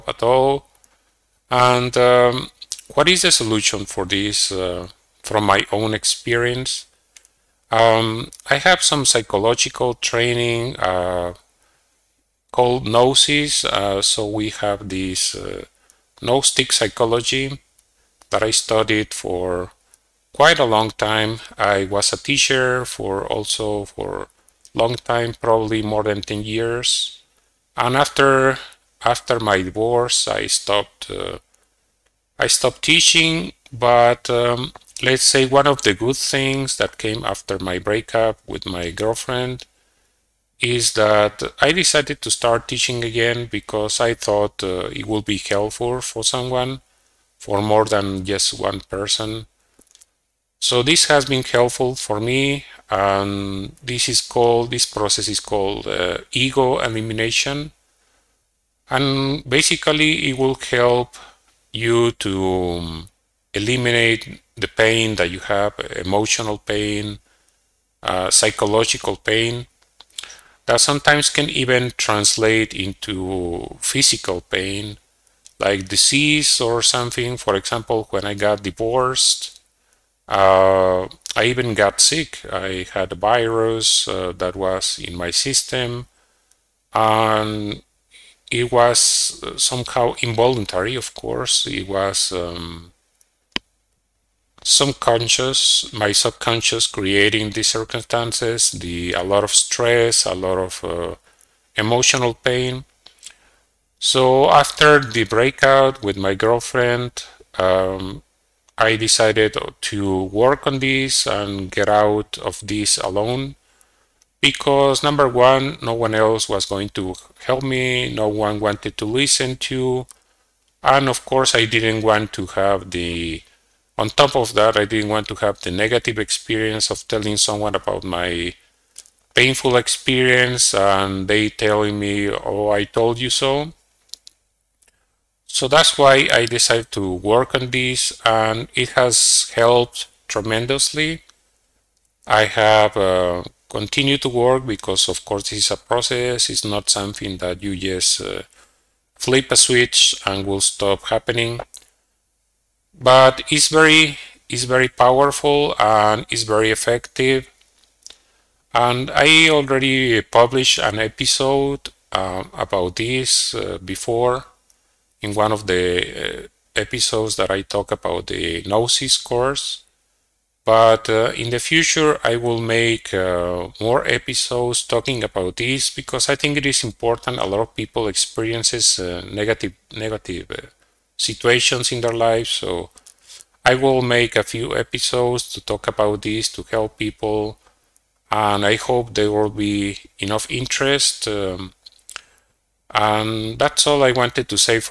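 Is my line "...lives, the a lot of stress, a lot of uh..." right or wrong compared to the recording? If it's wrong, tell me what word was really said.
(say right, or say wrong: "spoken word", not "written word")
wrong: "circumstances", not "lives".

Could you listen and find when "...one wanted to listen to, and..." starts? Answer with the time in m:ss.
1:58.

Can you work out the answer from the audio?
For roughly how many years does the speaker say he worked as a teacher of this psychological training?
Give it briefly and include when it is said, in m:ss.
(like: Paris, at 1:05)
more than 10 years, at 0:25.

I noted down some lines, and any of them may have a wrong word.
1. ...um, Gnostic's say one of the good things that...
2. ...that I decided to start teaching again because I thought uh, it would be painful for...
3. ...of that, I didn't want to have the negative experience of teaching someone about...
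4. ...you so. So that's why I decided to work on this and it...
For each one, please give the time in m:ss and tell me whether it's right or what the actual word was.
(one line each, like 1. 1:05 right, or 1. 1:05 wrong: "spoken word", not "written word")
1. 0:34 wrong: "Let", not "Gnostic"
2. 0:40 wrong: "helpful", not "painful"
3. 2:04 wrong: "telling", not "teaching"
4. 2:13 right.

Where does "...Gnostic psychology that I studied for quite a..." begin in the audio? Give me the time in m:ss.
0:16.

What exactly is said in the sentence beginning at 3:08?
And I hope there will be enough interest.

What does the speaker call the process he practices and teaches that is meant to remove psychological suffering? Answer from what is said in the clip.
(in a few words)
ego elimination.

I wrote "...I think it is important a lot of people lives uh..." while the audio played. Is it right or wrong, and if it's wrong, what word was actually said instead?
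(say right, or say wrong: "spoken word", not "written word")
wrong: "experiences", not "lives".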